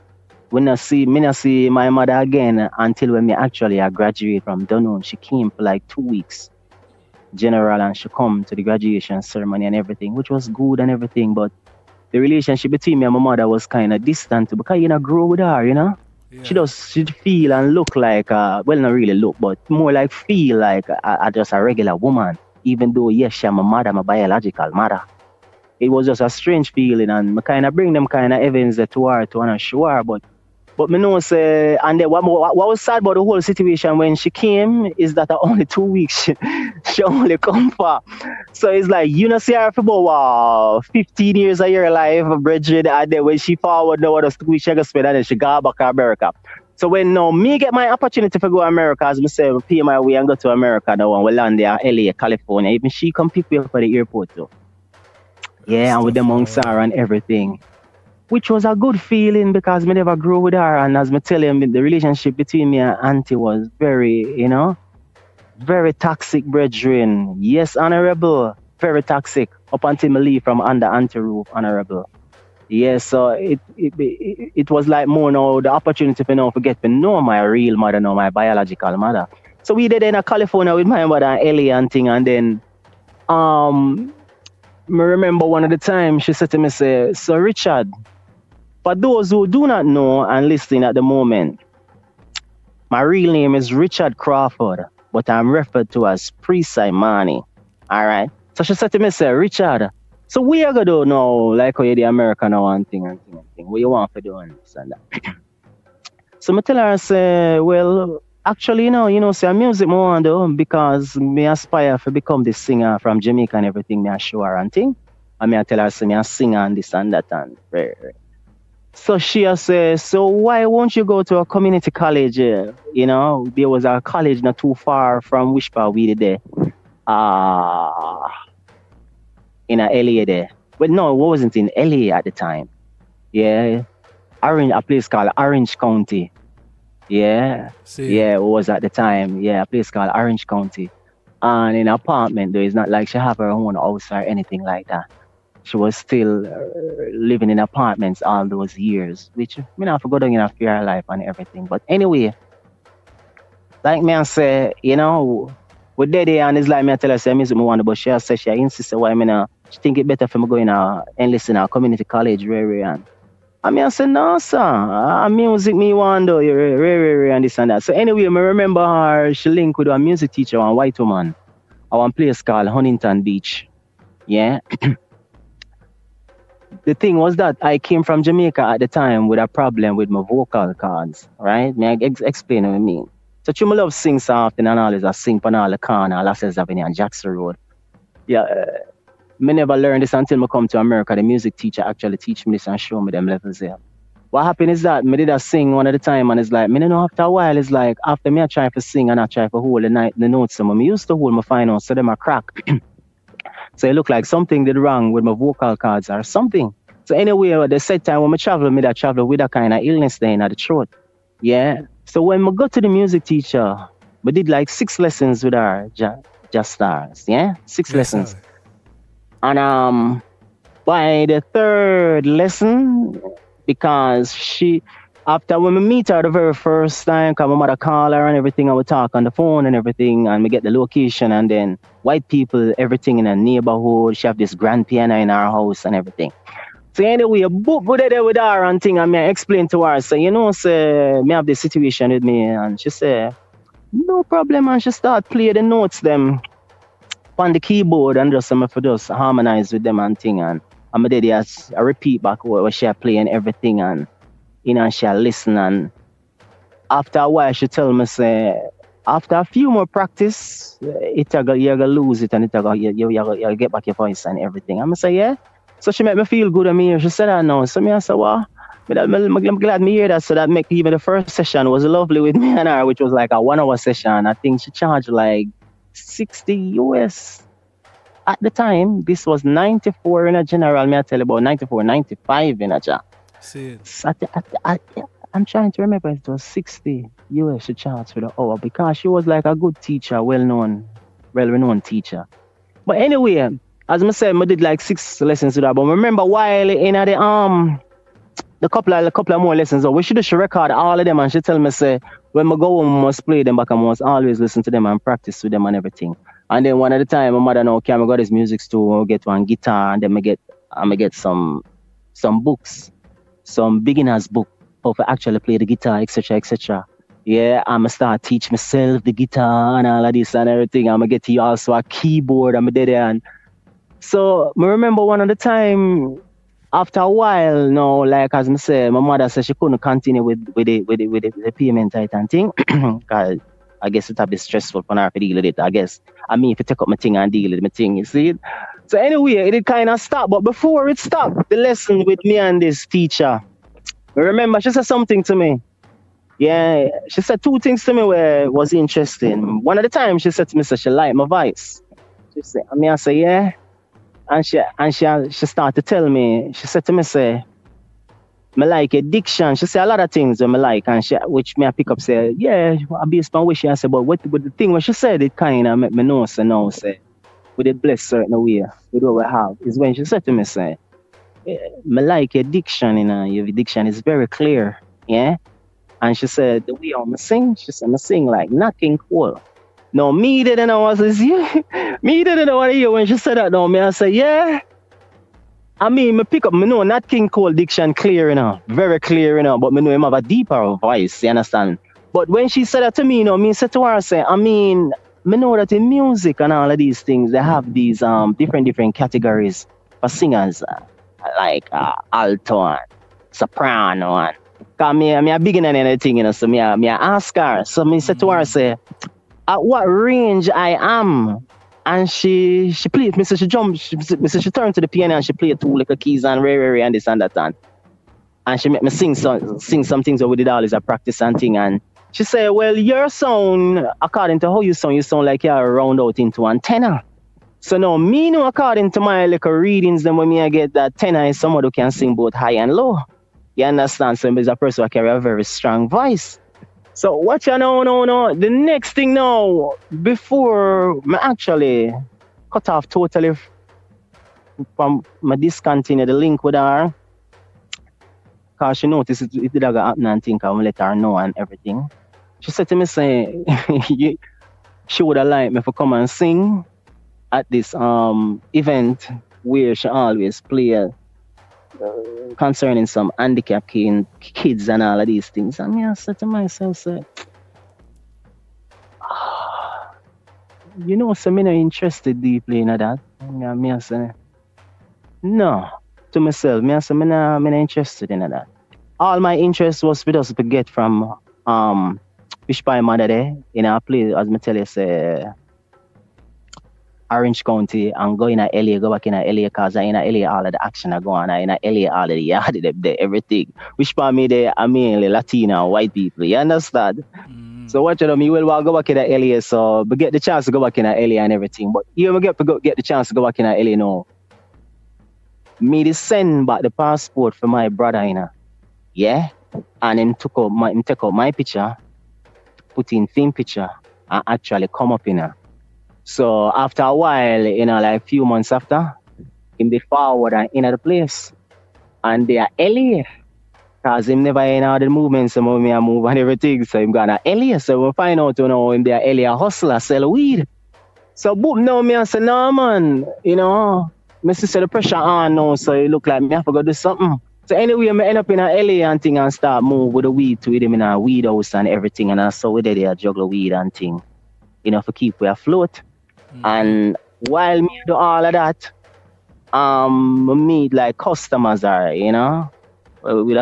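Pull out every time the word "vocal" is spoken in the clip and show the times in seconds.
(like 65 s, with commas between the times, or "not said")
180 s, 205 s.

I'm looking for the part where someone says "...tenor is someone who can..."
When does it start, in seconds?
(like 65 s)
430 s.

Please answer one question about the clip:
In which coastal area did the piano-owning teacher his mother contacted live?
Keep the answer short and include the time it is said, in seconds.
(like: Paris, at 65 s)
Huntington Beach, at 172 s.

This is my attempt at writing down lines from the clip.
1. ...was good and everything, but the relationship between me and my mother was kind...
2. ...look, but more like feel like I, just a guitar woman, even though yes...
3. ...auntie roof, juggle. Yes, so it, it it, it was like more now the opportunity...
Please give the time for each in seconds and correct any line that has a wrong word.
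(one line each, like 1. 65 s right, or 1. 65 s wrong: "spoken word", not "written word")
1. 10 s right
2. 19 s wrong: "regular", not "guitar"
3. 70 s wrong: "honorable", not "juggle".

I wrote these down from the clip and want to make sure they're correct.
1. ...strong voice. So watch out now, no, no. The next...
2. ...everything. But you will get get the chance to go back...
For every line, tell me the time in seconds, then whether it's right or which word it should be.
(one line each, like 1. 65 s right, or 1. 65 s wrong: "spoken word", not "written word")
1. 435 s right
2. 501 s right.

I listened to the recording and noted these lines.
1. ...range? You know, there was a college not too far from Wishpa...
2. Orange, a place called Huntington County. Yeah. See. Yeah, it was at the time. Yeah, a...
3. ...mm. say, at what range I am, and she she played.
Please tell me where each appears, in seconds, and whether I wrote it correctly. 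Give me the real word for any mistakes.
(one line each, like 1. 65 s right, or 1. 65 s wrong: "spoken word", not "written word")
1. 121 s wrong: "college", not "range"
2. 134 s wrong: "Orange", not "Huntington"
3. 408 s right.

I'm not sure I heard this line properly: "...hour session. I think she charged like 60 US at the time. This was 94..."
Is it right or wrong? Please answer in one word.
right.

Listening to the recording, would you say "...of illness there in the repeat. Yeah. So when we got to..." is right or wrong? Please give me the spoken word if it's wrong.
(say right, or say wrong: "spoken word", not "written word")
wrong: "throat", not "repeat".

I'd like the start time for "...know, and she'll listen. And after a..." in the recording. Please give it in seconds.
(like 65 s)
254 s.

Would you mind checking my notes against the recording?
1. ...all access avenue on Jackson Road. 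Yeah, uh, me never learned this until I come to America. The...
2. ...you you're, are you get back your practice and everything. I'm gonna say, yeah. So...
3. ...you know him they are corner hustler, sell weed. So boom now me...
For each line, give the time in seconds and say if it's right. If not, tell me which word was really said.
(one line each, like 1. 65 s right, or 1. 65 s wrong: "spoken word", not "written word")
1. 186 s right
2. 262 s wrong: "voice", not "practice"
3. 528 s wrong: "earlier", not "corner".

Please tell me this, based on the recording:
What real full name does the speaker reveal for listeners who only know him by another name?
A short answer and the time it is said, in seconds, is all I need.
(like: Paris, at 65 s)
Richard Crawford, at 93 s.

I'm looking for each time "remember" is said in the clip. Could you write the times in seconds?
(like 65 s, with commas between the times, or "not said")
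85 s, 168 s, 285 s, 295 s, 324 s, 344 s.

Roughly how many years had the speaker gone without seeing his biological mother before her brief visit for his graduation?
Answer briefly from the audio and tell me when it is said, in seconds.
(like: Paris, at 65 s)
15 years, at 40 s.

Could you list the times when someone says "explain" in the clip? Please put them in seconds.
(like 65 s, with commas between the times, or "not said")
182 s, 239 s.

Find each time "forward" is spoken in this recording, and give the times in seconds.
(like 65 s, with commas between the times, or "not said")
43 s, 519 s.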